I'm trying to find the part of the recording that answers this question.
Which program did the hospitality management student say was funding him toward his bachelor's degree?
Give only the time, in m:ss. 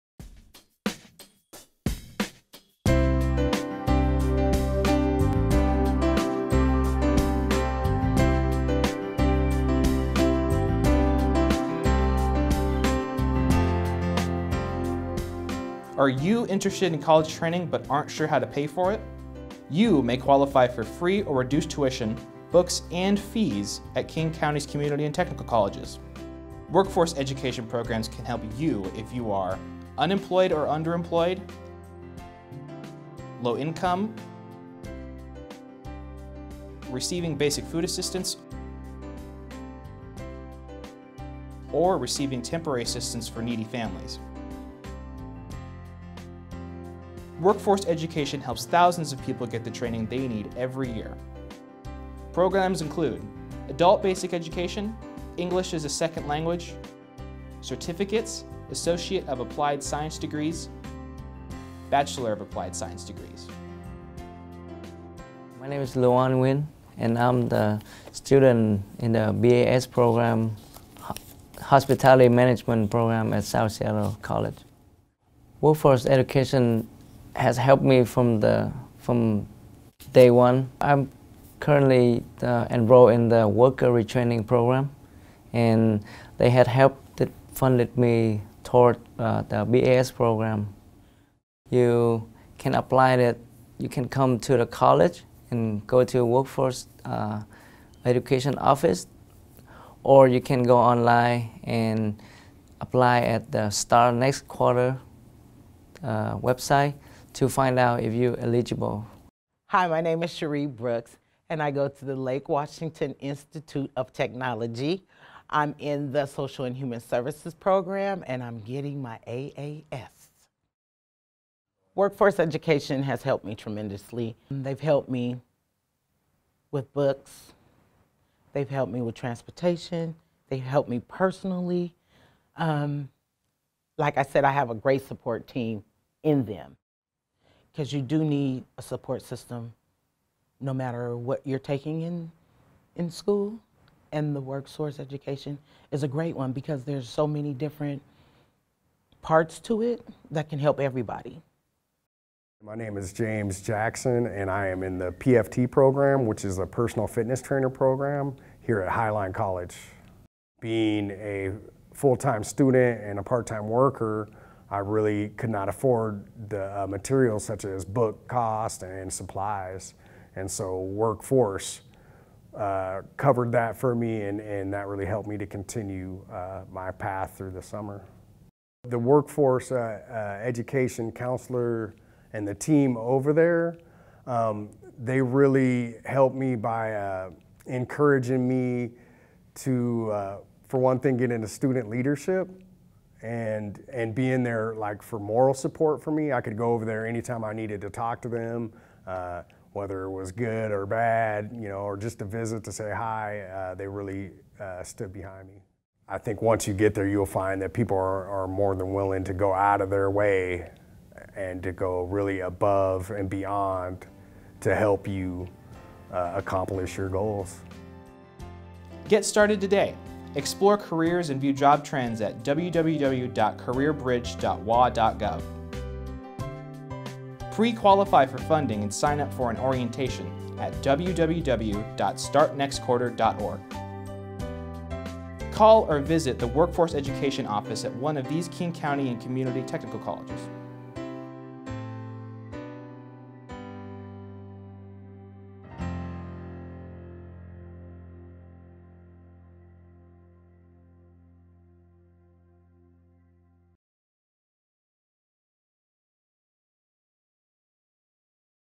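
1:23.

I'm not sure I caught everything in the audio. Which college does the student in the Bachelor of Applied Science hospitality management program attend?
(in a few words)
South Seattle College.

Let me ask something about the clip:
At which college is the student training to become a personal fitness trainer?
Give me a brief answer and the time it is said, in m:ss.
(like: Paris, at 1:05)
Highline College, at 2:38.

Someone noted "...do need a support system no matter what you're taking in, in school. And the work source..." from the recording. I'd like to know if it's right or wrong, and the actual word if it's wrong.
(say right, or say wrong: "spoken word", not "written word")
right.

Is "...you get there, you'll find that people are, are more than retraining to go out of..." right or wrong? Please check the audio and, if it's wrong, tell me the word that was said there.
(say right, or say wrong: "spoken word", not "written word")
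wrong: "willing", not "retraining".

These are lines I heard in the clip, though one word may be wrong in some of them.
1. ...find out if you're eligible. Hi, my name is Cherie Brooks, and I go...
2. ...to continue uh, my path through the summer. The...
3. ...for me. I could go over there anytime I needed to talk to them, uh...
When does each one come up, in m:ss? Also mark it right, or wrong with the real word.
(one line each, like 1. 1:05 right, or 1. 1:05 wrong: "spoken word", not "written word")
1. 1:47 right
2. 2:55 right
3. 3:16 right.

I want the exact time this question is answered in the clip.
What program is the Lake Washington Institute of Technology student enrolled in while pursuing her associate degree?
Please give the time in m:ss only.
1:56.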